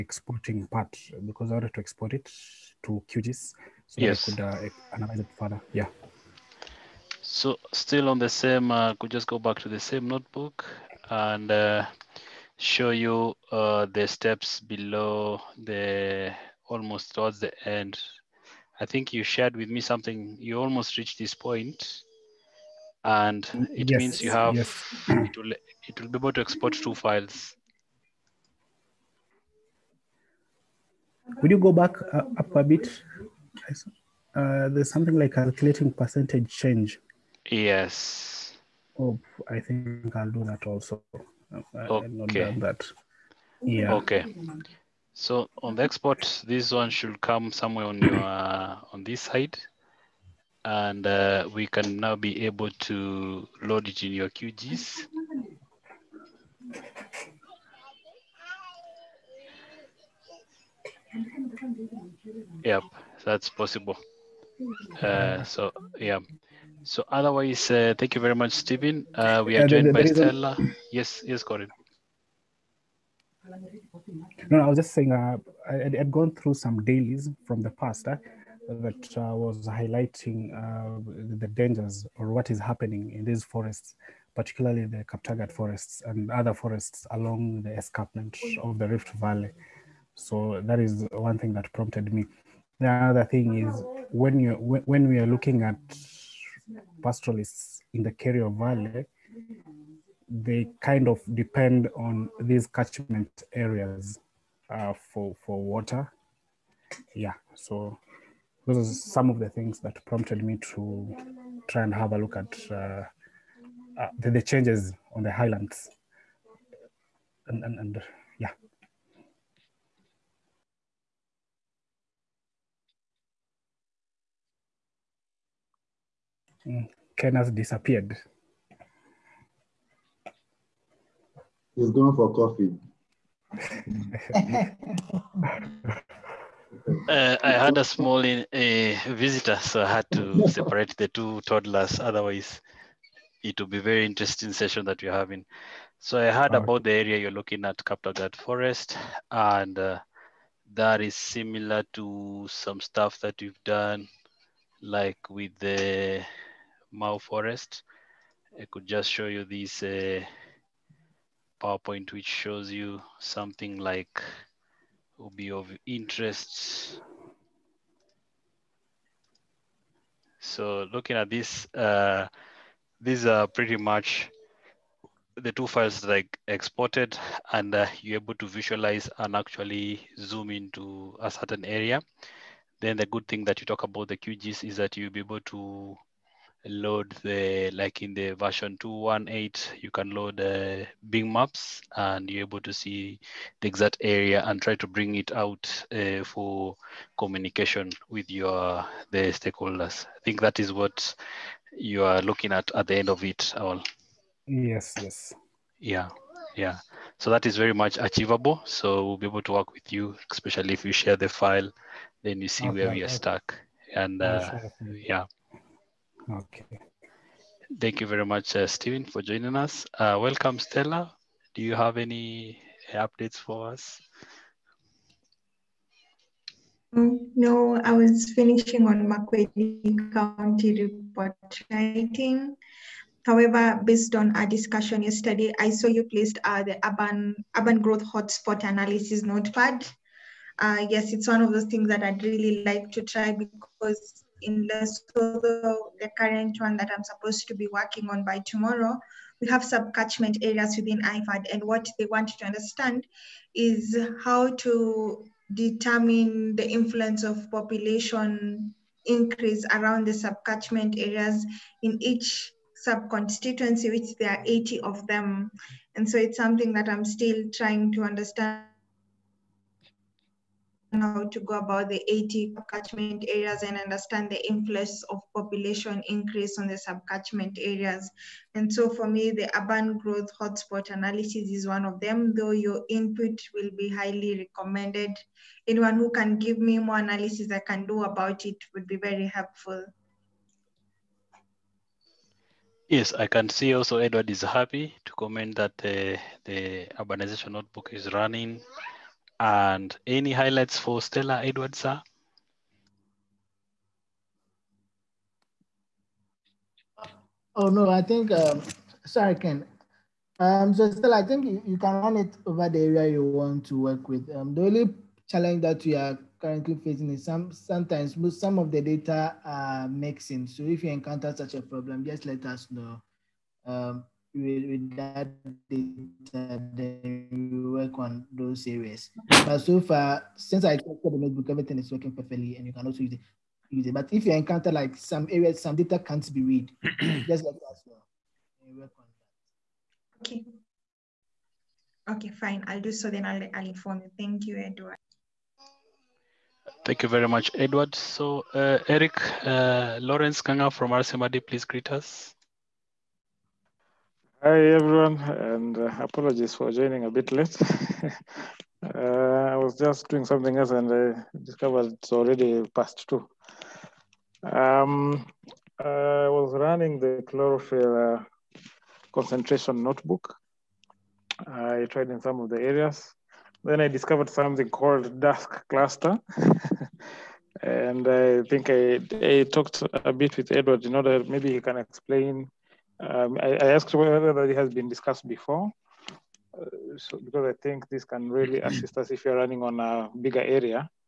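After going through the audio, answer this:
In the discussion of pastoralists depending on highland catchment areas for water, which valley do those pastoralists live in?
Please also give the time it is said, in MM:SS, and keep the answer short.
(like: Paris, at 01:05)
Kerio Valley, at 01:38.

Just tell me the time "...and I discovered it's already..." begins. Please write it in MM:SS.
06:00.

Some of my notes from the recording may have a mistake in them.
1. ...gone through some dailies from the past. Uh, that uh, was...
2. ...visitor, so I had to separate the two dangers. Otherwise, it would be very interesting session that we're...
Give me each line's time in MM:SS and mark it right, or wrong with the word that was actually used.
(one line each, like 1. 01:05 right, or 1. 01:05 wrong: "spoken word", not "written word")
1. 01:16 right
2. 02:19 wrong: "toddlers", not "dangers".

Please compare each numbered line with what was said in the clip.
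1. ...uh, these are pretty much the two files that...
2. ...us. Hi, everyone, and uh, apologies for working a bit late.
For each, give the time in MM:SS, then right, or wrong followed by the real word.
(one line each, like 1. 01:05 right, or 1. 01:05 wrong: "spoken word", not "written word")
1. 02:51 right
2. 05:51 wrong: "joining", not "working".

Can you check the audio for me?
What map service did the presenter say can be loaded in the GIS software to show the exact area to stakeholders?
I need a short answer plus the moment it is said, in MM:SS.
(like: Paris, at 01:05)
Bing Maps, at 03:11.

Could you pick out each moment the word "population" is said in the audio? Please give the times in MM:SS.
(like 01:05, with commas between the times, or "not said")
04:17, 04:35.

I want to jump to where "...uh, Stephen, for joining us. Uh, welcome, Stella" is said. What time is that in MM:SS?
03:38.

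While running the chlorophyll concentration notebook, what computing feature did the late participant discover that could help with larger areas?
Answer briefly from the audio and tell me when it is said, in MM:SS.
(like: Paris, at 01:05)
Dask Cluster, at 06:15.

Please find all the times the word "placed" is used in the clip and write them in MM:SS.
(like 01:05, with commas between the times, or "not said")
03:56.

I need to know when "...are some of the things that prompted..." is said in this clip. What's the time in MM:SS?
01:48.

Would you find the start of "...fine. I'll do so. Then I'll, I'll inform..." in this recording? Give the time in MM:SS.
05:42.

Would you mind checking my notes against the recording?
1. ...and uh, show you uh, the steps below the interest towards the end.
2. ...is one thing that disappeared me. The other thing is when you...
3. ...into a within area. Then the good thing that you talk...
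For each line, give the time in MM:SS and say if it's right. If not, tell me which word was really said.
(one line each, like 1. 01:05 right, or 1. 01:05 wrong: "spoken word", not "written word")
1. 00:11 wrong: "almost", not "interest"
2. 01:30 wrong: "prompted", not "disappeared"
3. 03:00 wrong: "certain", not "within".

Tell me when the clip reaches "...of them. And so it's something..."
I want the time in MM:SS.
04:24.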